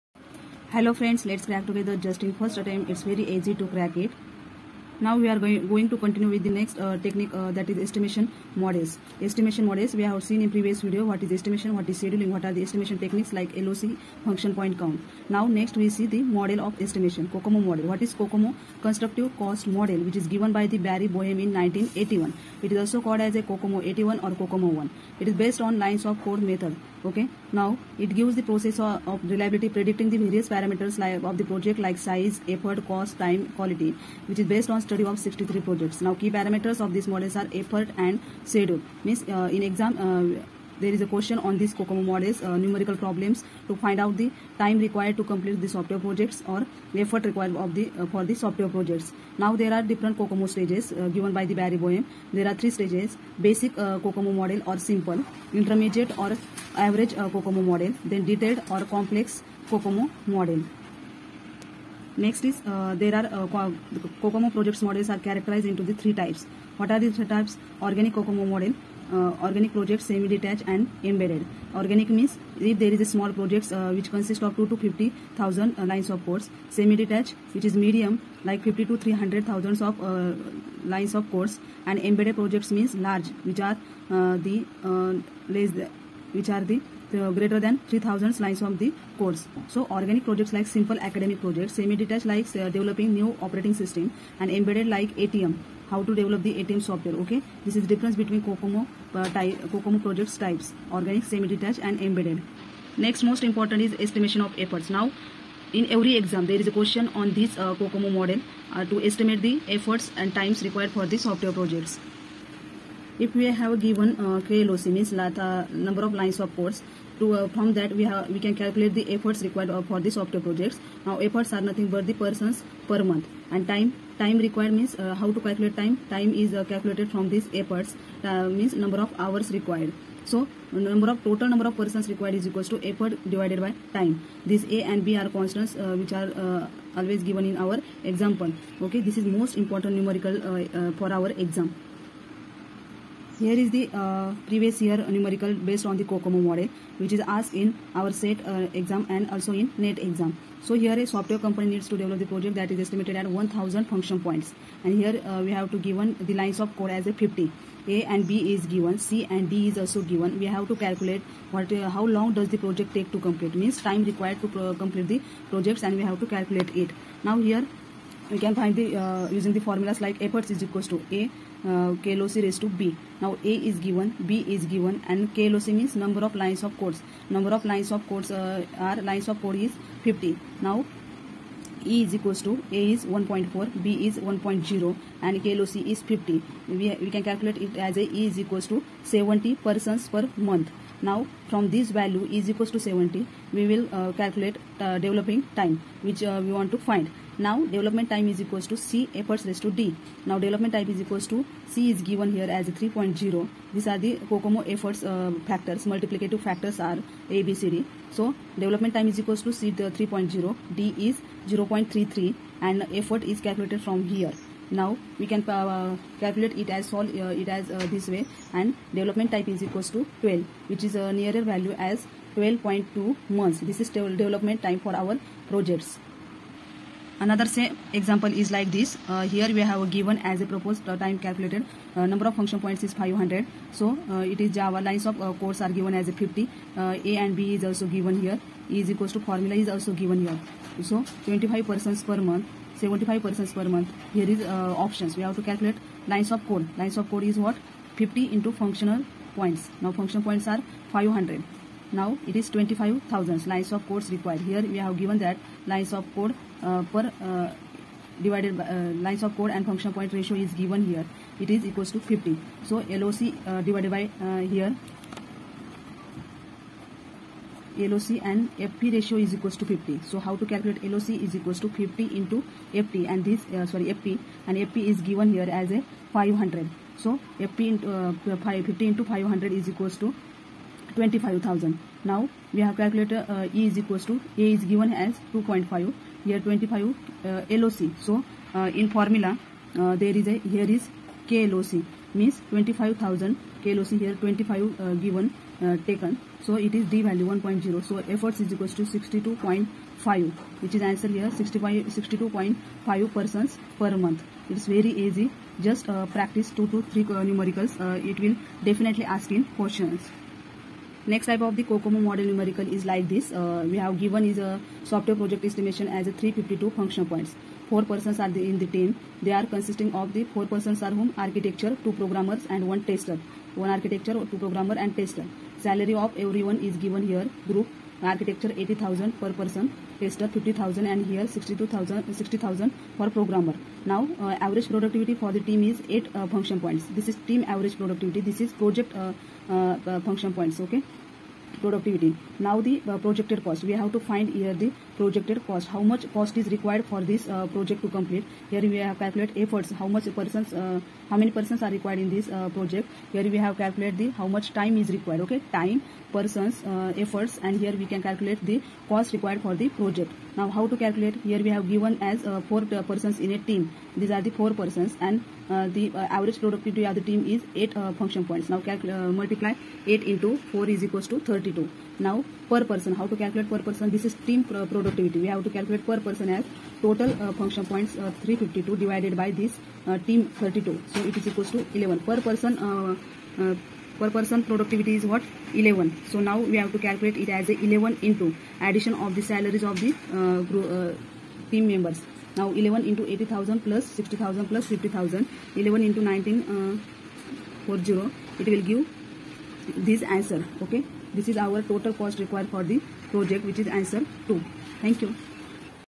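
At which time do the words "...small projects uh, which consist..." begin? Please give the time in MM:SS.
01:13.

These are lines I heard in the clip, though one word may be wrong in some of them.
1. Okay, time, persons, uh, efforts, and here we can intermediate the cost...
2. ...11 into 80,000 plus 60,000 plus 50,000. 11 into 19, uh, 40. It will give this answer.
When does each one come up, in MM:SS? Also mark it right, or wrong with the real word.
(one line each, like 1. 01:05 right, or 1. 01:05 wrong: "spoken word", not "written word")
1. 05:55 wrong: "calculate", not "intermediate"
2. 06:32 right.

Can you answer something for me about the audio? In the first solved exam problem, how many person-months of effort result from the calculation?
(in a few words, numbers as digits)
70.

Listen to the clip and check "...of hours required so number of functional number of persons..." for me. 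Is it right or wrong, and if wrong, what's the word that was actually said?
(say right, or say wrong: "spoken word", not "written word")
wrong: "total", not "functional".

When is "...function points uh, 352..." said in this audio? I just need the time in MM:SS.
06:17.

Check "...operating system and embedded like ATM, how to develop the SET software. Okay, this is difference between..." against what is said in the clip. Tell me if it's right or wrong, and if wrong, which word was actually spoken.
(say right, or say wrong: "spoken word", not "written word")
wrong: "ATM", not "SET".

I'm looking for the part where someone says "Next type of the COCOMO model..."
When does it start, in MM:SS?
05:11.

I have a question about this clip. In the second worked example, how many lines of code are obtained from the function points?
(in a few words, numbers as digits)
25,000.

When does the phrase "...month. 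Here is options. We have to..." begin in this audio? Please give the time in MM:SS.
04:03.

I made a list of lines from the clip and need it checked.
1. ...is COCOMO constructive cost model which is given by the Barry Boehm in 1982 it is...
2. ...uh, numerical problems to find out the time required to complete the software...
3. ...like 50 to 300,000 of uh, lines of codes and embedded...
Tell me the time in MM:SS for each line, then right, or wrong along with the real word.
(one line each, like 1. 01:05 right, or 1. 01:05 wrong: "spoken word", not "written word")
1. 00:18 wrong: "1981", not "1982"
2. 00:42 right
3. 01:18 right.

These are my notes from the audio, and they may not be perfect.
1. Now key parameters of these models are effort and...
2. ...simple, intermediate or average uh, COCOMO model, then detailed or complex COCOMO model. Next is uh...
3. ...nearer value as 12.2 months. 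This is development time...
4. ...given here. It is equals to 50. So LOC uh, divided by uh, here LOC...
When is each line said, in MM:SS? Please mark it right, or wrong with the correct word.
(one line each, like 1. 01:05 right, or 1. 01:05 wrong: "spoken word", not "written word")
1. 00:36 right
2. 00:54 right
3. 03:41 right
4. 04:20 right.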